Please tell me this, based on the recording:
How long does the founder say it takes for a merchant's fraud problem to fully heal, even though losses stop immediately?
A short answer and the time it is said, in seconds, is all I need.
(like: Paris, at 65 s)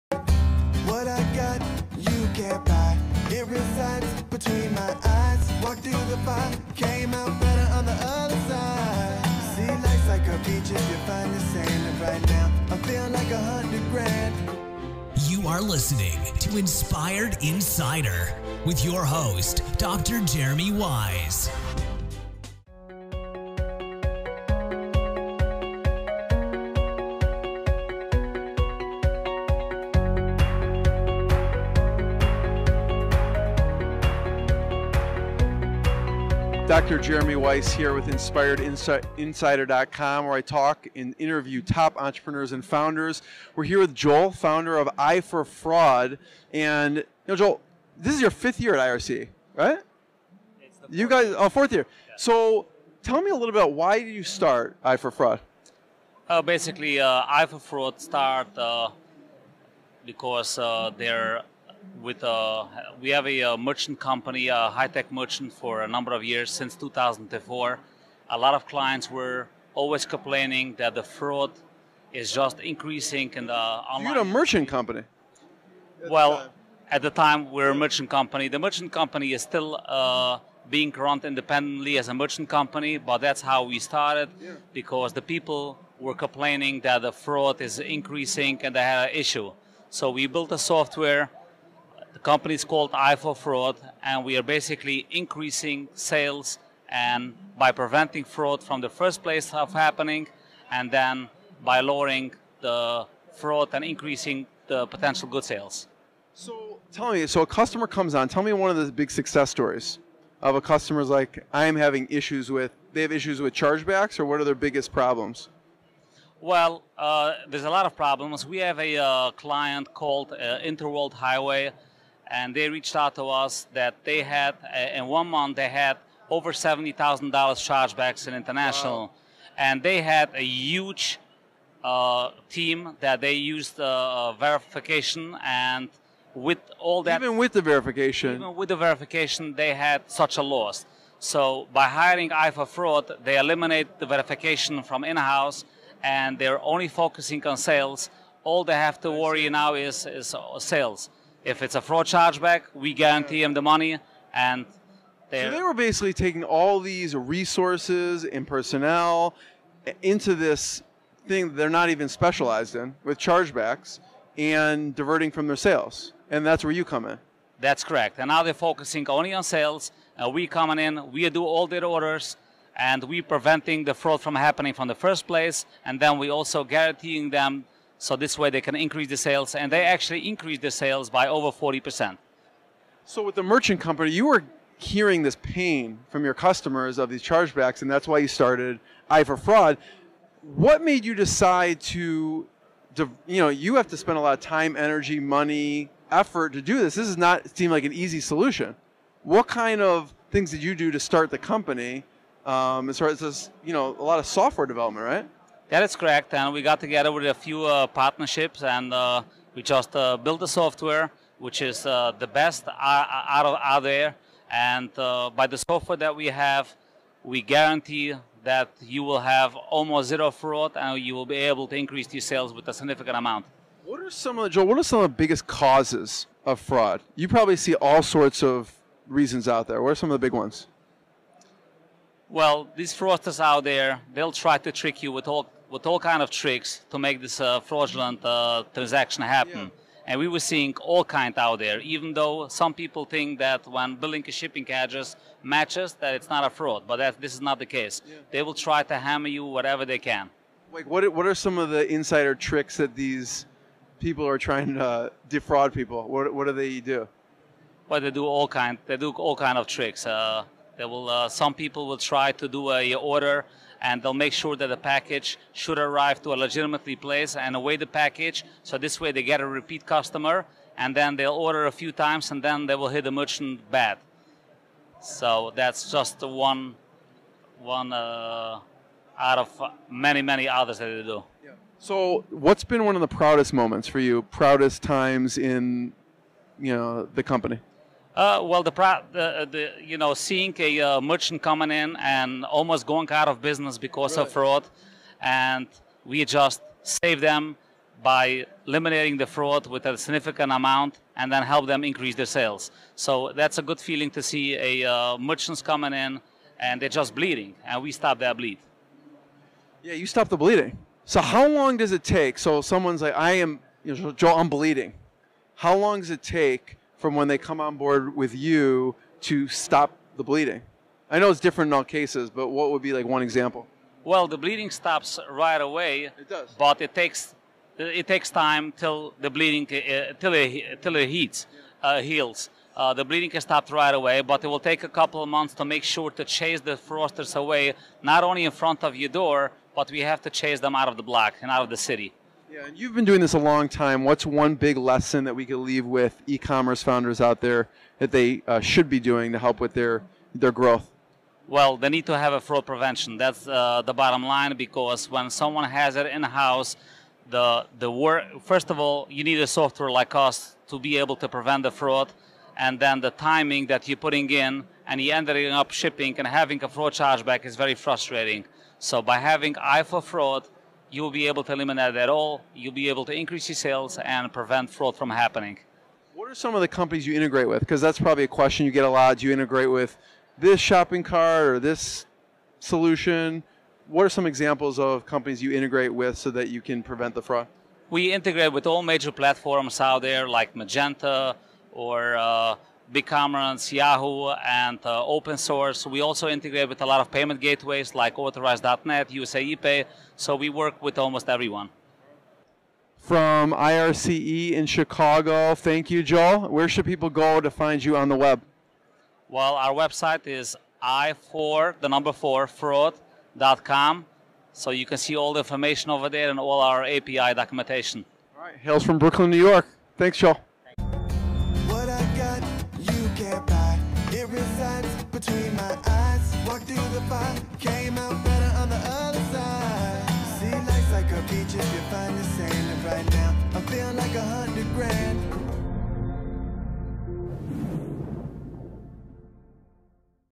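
a couple of months, at 334 s.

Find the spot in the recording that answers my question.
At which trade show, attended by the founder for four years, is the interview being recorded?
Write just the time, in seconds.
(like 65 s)
403 s.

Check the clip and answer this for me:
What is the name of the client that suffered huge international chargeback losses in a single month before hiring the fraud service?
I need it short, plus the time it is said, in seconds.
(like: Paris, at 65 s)
Interworld Highway, at 120 s.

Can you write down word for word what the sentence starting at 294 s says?
of fraud, and we just save them by eliminating the fraud with a significant amount and then help them increase their sales.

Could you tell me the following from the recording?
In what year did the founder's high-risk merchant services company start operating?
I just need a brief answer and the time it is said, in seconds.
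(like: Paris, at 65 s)
2004, at 66 s.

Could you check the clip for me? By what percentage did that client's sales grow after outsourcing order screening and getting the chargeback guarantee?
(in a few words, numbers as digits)
over 40%.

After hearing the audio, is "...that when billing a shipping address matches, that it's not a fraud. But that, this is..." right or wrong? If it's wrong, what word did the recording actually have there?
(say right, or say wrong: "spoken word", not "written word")
right.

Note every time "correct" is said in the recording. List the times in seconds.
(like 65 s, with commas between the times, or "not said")
167 s, 205 s.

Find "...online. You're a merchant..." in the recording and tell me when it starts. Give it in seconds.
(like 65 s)
73 s.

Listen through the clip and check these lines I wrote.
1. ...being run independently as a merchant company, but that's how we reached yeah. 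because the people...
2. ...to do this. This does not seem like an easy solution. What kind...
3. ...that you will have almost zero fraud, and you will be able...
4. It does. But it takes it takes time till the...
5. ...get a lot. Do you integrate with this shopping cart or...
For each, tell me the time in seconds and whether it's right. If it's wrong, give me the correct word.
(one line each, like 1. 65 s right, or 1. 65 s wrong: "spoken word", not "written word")
1. 80 s wrong: "started", not "reached"
2. 196 s right
3. 218 s right
4. 326 s right
5. 378 s right.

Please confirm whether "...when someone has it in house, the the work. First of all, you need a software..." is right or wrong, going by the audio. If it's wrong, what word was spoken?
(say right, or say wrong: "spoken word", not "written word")
right.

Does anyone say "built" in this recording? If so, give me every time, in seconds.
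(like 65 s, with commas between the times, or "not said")
90 s, 210 s.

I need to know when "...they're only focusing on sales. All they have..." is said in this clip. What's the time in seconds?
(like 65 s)
146 s.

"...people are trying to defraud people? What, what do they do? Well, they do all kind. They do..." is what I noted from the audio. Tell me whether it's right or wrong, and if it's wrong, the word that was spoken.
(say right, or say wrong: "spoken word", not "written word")
right.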